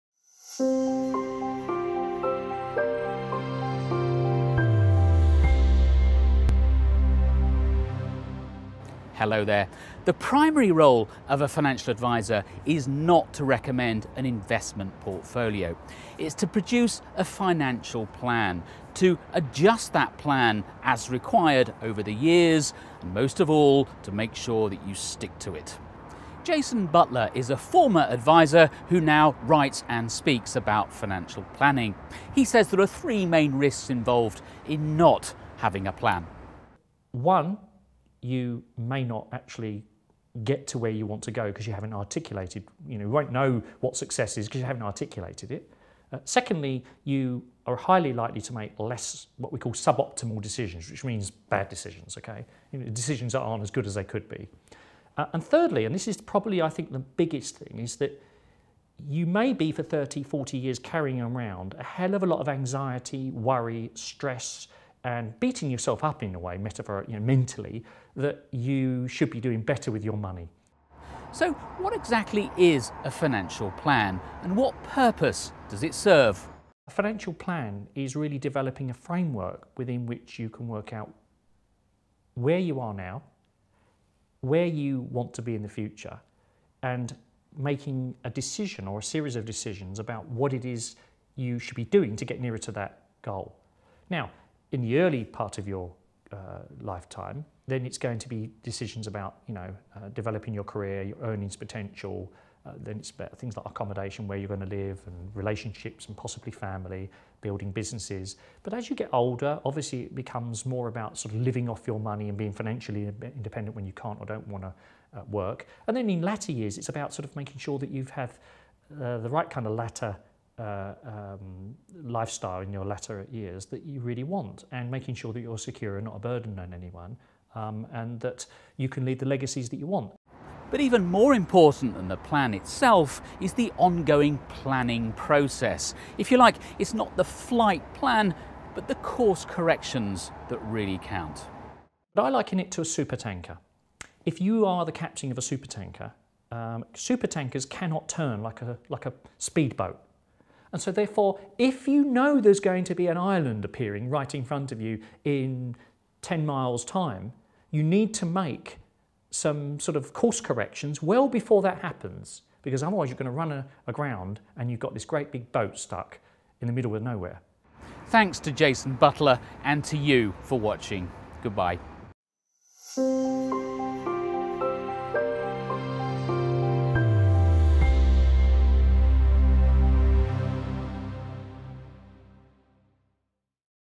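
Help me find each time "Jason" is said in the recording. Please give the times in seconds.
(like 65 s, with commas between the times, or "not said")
26 s, 168 s.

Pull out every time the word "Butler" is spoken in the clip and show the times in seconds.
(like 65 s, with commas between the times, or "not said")
26 s, 168 s.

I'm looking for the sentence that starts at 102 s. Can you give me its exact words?
Uh, then it's about things like accommodation, where you're going to live, and relationships, and possibly family, building businesses.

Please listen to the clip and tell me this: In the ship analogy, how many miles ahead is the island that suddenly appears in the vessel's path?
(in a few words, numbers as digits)
10.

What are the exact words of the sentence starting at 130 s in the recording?
But even more important than the plan itself is the ongoing planning process.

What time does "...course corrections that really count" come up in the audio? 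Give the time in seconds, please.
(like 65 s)
138 s.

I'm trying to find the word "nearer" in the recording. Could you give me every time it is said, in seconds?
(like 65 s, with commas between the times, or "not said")
92 s.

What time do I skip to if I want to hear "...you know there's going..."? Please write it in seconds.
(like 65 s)
151 s.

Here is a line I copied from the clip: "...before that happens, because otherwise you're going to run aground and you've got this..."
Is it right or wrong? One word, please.
right.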